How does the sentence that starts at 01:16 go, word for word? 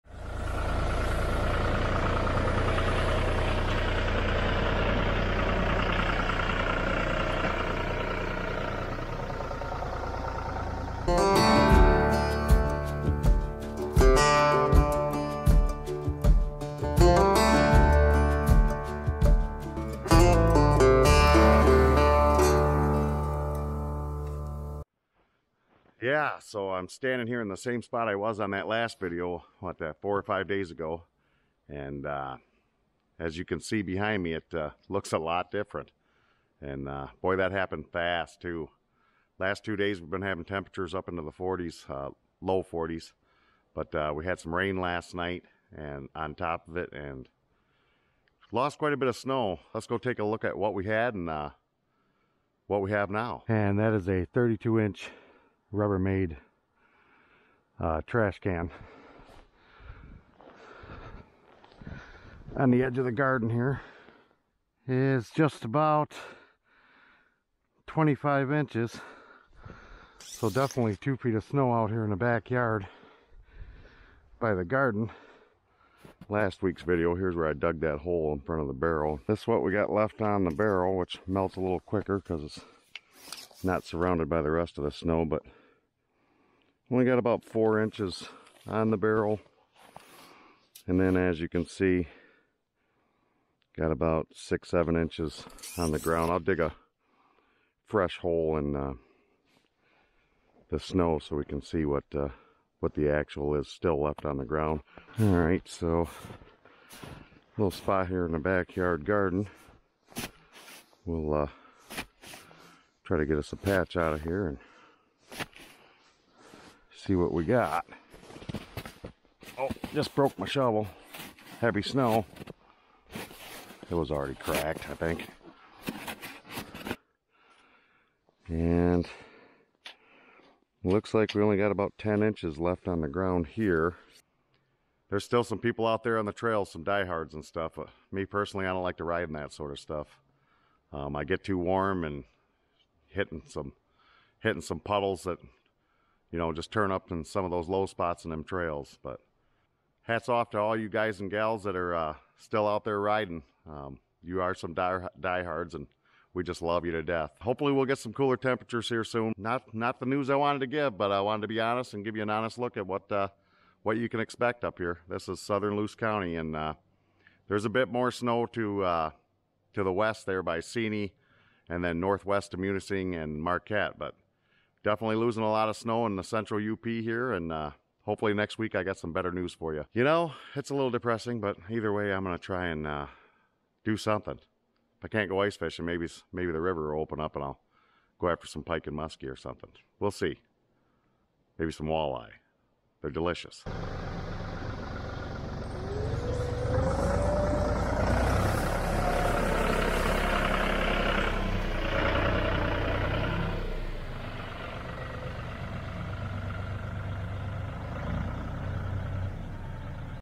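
Last week's video, here's where I dug that hole in front of the barrel.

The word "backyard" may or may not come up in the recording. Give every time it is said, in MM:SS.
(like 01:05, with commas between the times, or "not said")
01:12, 01:48.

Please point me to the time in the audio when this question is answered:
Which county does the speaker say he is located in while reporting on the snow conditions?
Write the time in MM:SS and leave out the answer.
02:45.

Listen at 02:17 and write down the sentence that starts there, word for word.
But me personally, I don't like to ride in that sort of stuff.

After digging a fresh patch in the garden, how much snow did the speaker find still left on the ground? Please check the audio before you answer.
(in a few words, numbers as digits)
10 inches.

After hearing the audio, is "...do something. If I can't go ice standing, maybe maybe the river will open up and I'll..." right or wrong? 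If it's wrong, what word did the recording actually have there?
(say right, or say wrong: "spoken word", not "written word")
wrong: "fishing", not "standing".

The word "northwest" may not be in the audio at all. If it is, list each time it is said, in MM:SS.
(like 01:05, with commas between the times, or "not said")
02:51.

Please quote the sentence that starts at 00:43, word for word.
But uh, we had some rain last night and on top of it and lost quite a bit of snow.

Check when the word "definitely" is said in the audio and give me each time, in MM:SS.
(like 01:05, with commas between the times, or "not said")
01:10, 02:54.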